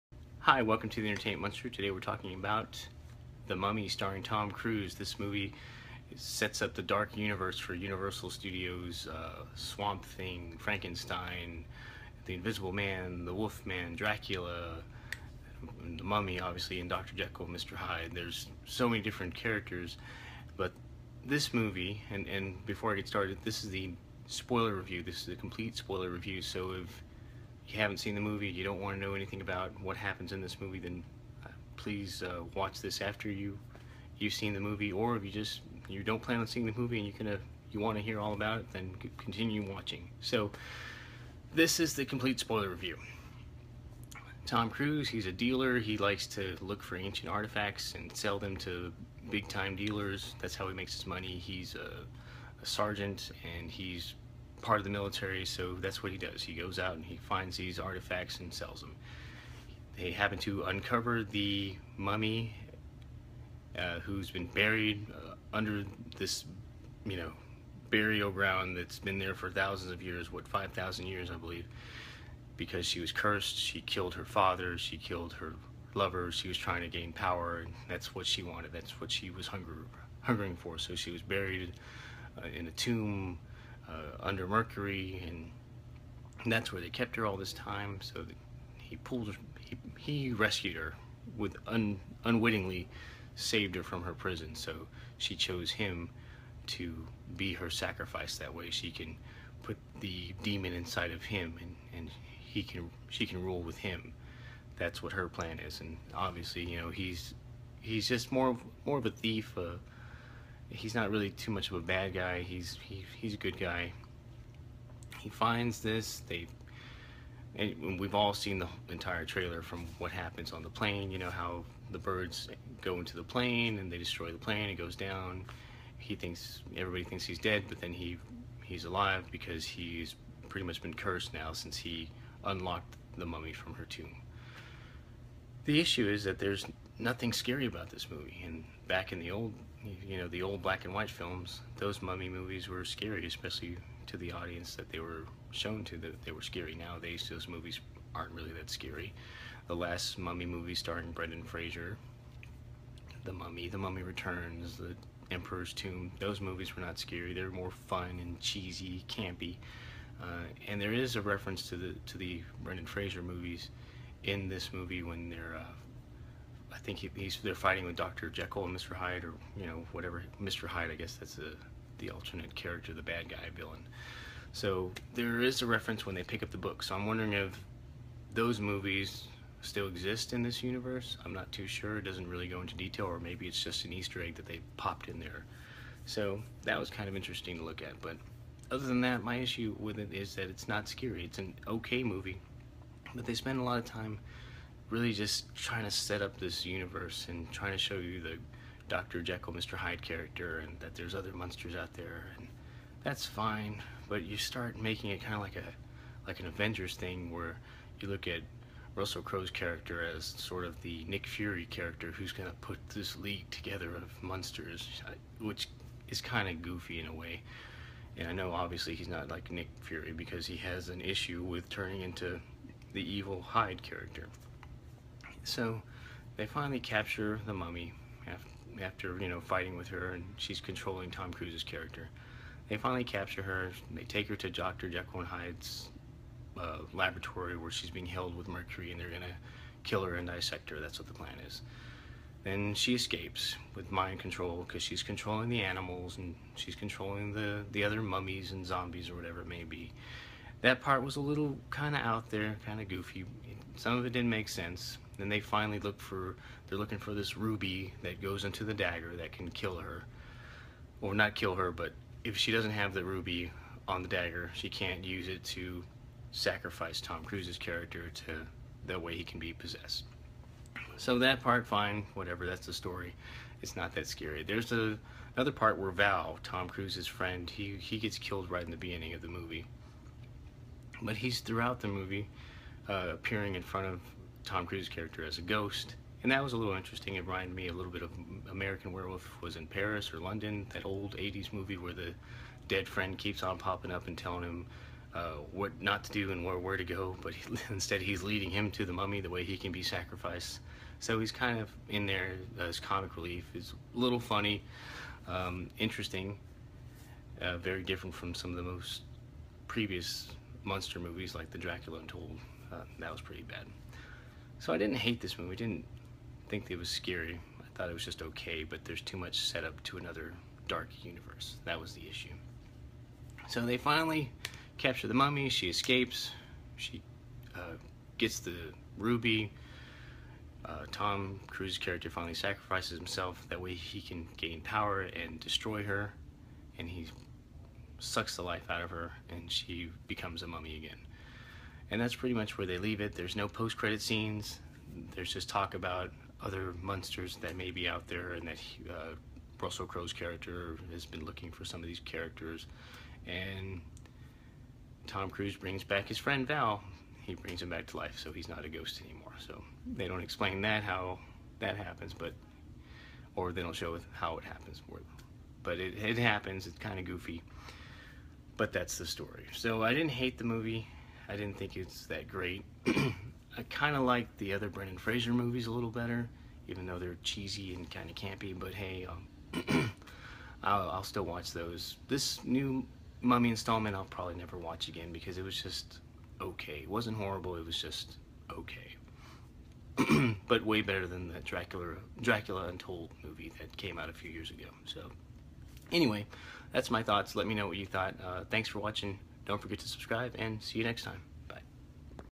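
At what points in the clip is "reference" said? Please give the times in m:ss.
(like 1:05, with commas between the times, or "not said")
2:41, 2:55.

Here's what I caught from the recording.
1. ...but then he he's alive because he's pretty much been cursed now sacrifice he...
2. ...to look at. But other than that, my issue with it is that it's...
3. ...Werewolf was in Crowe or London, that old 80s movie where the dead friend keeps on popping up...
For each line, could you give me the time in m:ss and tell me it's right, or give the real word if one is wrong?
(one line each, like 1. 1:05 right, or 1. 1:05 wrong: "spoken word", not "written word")
1. 2:07 wrong: "since", not "sacrifice"
2. 3:07 right
3. 4:48 wrong: "Paris", not "Crowe".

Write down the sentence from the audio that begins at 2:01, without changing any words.
You know how the birds go into the plane and they destroy the plane.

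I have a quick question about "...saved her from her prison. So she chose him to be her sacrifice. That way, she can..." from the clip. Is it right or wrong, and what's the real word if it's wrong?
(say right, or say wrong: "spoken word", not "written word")
right.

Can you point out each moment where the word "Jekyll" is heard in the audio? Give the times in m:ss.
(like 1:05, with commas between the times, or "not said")
0:17, 2:48, 3:19, 3:54.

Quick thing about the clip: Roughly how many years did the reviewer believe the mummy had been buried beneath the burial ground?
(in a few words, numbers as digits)
5,000 years.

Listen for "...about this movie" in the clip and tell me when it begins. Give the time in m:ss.
2:17.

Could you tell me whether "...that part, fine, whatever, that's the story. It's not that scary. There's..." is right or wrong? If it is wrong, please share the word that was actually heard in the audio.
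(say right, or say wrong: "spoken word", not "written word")
right.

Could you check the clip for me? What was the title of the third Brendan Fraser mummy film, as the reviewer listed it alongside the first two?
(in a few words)
The Emperor's Tomb.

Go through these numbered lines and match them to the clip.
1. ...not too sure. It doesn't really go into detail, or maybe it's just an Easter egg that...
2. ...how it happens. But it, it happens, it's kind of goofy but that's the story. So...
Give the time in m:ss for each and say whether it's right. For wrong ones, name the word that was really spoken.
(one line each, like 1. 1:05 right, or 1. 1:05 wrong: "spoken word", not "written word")
1. 3:01 right
2. 6:04 right.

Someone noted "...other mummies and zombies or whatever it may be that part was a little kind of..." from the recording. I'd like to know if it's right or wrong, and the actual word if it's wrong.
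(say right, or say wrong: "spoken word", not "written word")
right.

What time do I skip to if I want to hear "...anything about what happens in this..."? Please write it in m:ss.
0:29.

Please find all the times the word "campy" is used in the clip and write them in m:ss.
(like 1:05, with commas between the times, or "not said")
2:39, 6:18.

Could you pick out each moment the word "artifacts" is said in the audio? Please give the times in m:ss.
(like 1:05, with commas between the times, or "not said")
0:47, 0:57.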